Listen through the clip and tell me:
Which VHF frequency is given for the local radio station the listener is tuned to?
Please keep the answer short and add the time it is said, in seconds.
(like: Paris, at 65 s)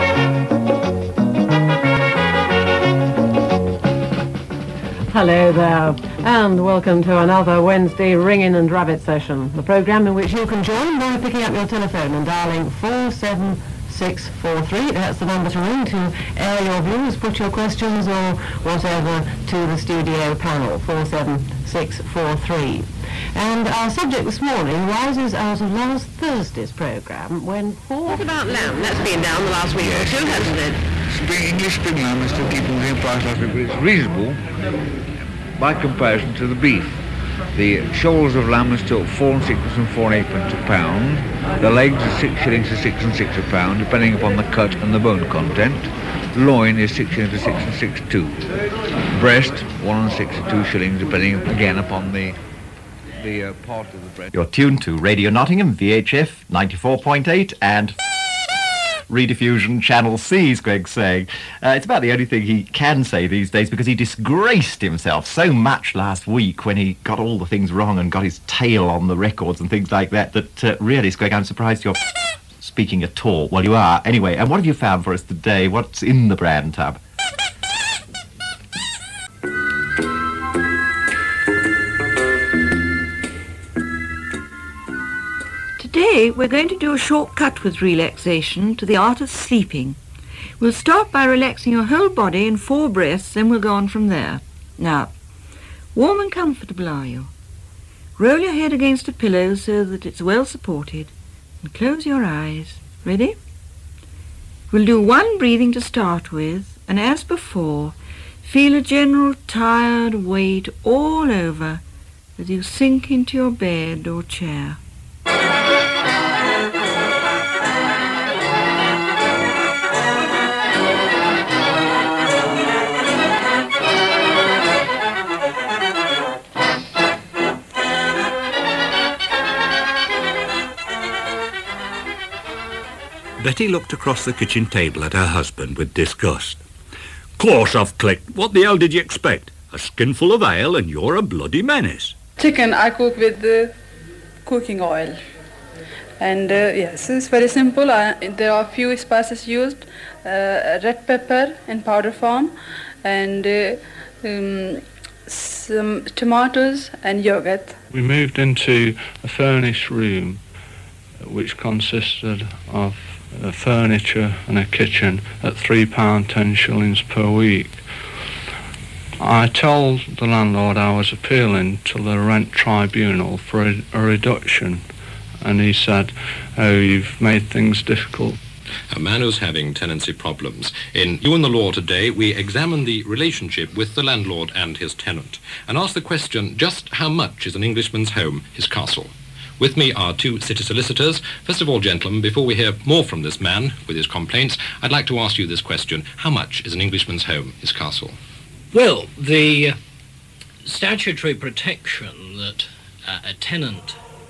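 94.8, at 56 s.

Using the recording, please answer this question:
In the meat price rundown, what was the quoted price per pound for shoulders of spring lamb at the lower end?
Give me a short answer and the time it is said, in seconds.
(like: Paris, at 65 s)
4s 6d, at 39 s.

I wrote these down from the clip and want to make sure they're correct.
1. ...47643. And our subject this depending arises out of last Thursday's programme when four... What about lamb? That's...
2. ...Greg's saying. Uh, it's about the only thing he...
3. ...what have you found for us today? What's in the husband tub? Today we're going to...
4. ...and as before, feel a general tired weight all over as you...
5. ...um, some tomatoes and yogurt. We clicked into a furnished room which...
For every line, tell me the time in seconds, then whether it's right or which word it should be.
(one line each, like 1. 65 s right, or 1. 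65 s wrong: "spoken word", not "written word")
1. 20 s wrong: "morning", not "depending"
2. 60 s right
3. 74 s wrong: "brand", not "husband"
4. 106 s right
5. 154 s wrong: "moved", not "clicked".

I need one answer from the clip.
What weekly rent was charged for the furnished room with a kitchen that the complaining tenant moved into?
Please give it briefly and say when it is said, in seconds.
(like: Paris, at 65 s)
£3 10s, at 165 s.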